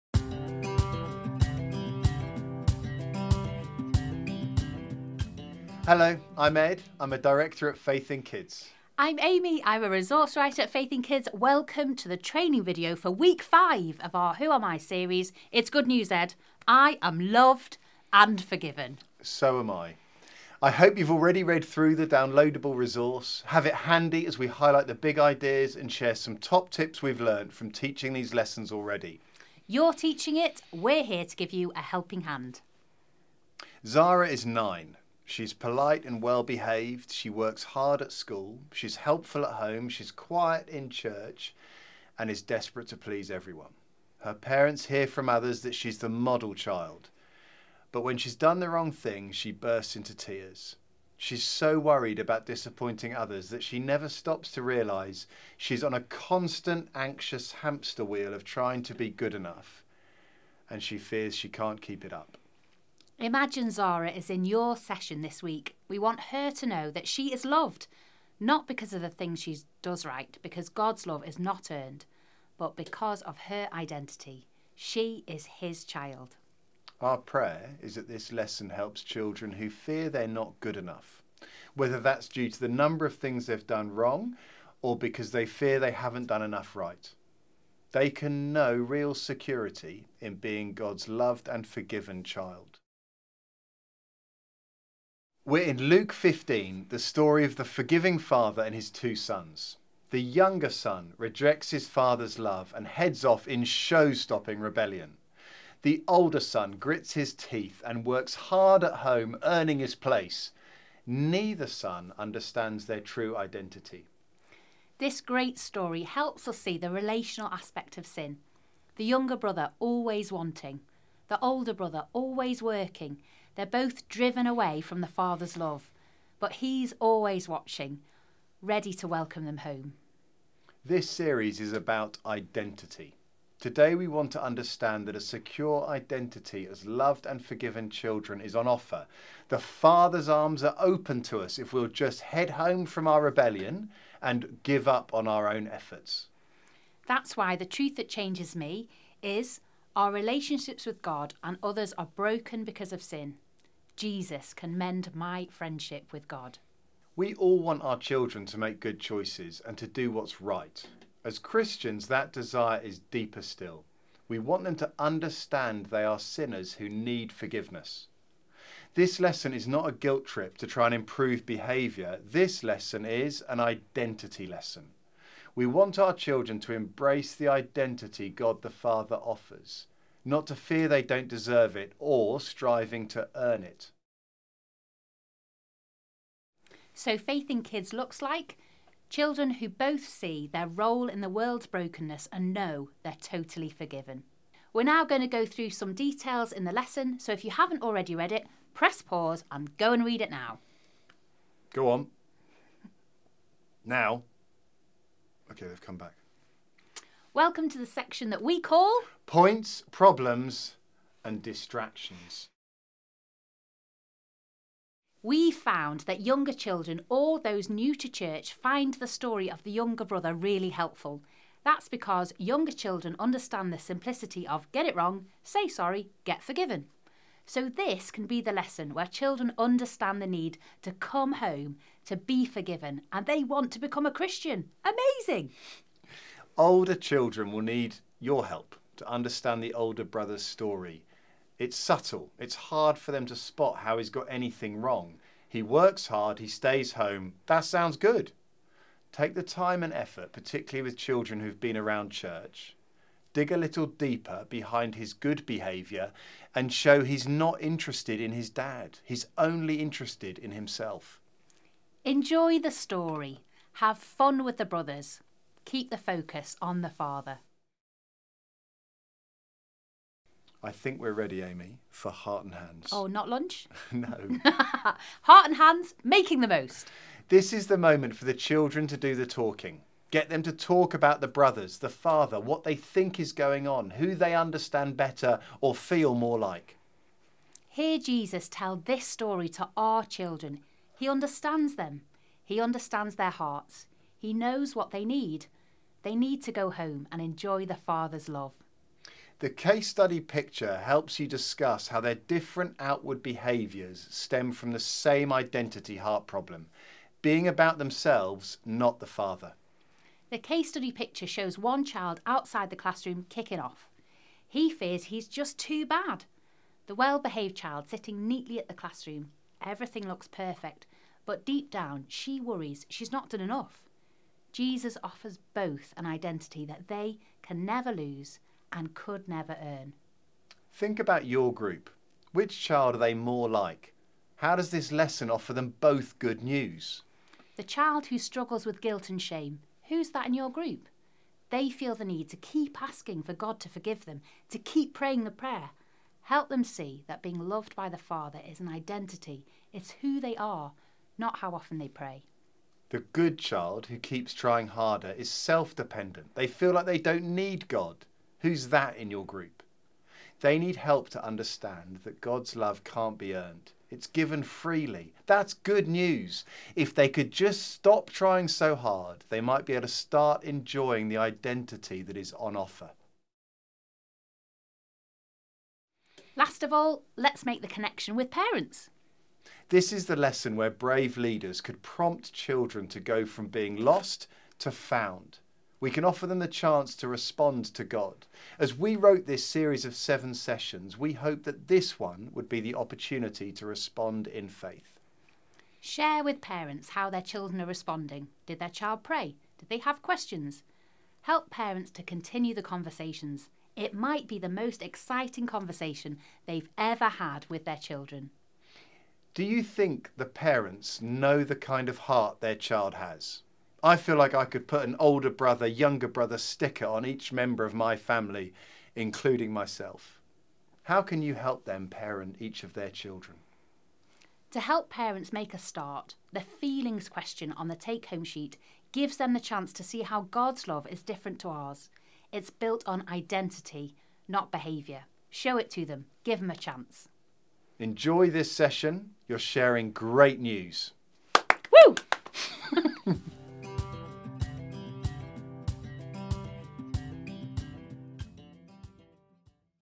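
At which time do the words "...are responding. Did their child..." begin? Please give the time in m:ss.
6:37.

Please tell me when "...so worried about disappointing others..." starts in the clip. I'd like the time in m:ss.
0:51.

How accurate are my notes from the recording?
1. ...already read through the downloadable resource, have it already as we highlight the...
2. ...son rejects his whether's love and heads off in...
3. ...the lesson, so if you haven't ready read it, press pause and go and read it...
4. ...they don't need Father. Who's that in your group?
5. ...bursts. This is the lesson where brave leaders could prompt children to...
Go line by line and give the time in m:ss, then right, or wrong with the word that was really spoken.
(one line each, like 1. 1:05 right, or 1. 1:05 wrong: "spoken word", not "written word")
1. 0:21 wrong: "handy", not "already"
2. 1:40 wrong: "father", not "whether"
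3. 3:16 wrong: "already", not "ready"
4. 5:56 wrong: "God", not "Father"
5. 6:18 wrong: "parents", not "bursts".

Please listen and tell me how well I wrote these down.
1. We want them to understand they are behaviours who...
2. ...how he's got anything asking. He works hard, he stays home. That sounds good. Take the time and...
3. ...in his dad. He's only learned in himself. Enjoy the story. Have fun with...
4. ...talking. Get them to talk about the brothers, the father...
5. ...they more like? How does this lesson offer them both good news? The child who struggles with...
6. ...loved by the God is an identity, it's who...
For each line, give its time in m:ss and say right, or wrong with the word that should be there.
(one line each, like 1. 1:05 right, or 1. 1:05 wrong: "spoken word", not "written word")
1. 2:44 wrong: "sinners", not "behaviours"
2. 4:03 wrong: "wrong", not "asking"
3. 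4:18 wrong: "interested", not "learned"
4. 4:39 right
5. 5:32 right
6. 5:47 wrong: "Father", not "God".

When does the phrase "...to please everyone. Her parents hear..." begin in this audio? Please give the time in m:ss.
0:42.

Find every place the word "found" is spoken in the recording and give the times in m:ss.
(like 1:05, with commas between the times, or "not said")
3:35, 6:24.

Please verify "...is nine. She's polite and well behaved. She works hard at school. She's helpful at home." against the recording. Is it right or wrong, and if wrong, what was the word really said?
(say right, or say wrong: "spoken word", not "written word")
right.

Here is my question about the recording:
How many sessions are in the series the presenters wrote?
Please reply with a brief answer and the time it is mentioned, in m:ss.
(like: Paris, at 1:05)
7, at 6:29.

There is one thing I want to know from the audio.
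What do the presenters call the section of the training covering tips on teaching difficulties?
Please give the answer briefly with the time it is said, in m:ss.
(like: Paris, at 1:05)
Points, Problems and Distractions, at 3:29.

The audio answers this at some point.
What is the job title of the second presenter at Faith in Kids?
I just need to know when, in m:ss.
0:09.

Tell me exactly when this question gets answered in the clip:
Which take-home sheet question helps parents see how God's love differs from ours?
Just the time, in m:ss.
7:06.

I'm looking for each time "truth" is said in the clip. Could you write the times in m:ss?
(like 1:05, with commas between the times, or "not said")
2:27.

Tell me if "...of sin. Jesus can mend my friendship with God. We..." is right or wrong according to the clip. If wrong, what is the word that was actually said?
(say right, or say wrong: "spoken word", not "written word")
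right.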